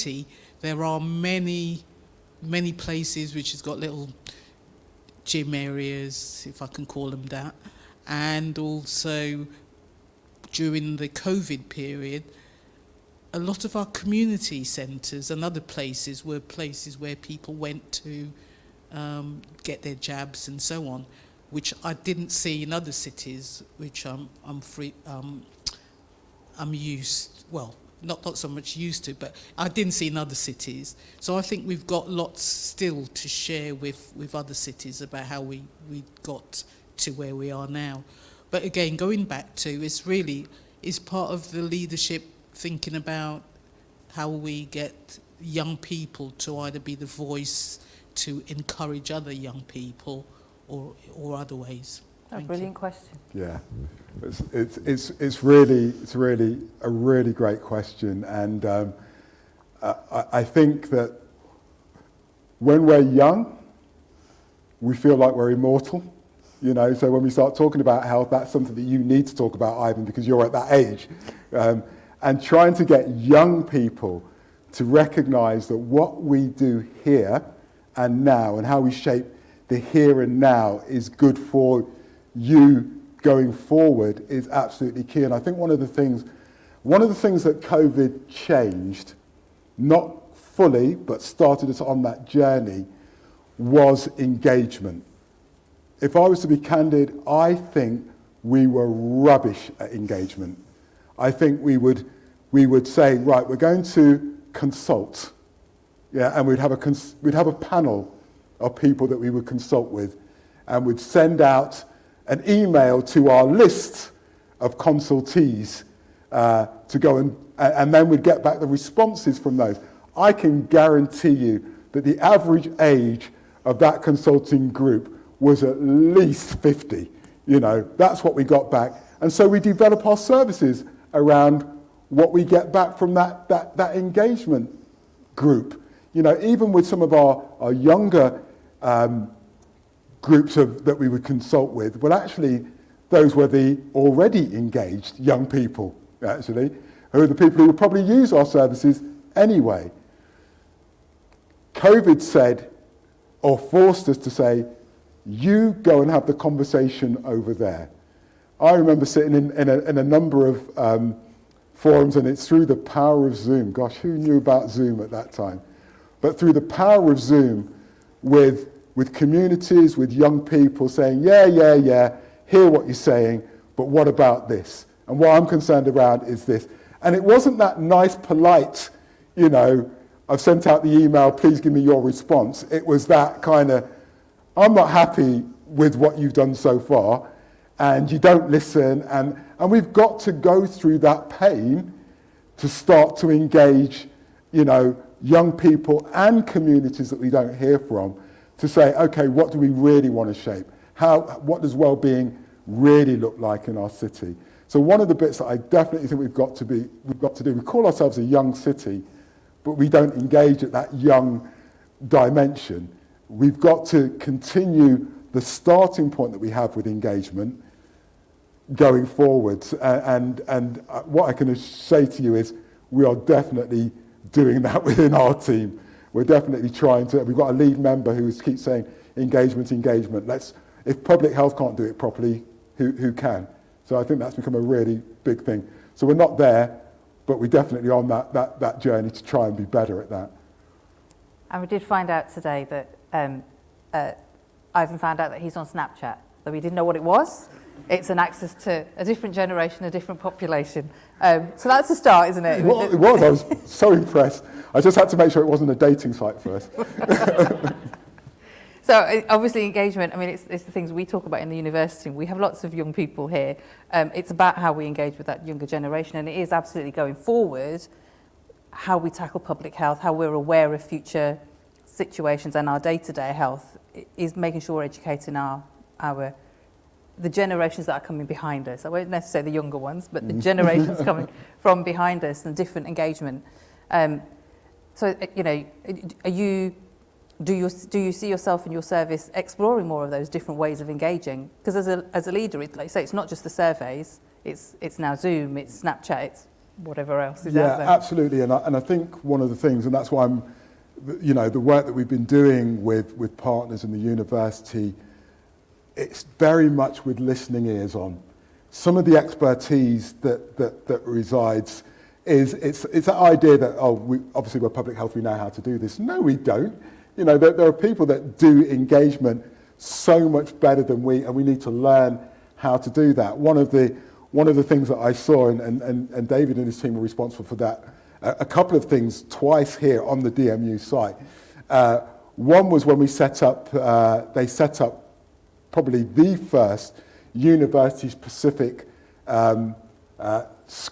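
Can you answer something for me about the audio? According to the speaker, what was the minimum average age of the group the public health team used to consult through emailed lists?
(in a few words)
50.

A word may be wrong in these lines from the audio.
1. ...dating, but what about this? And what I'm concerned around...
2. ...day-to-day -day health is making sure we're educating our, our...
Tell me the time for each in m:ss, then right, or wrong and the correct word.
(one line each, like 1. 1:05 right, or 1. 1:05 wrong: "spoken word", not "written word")
1. 2:52 wrong: "saying", not "dating"
2. 4:32 right.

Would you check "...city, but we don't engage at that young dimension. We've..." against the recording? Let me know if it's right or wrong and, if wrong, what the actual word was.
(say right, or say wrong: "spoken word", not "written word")
right.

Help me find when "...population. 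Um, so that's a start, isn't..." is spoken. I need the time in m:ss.
4:10.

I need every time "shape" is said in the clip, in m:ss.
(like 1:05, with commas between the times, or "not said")
1:18, 3:20.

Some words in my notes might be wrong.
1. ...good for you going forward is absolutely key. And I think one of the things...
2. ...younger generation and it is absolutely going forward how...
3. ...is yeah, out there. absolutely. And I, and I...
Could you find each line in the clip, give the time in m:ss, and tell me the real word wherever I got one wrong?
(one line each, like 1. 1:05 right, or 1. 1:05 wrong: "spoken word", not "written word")
1. 1:21 right
2. 4:25 right
3. 4:57 right.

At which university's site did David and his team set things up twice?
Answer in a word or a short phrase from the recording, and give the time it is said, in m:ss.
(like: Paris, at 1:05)
DMU, at 5:30.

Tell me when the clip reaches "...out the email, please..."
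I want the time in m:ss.
3:00.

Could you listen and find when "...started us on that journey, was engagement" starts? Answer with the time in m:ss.
1:31.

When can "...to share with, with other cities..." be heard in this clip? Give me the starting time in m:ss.
0:33.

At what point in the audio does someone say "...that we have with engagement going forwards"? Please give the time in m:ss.
3:36.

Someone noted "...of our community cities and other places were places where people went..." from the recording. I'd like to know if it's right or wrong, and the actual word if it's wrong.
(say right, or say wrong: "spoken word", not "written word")
wrong: "centres", not "cities".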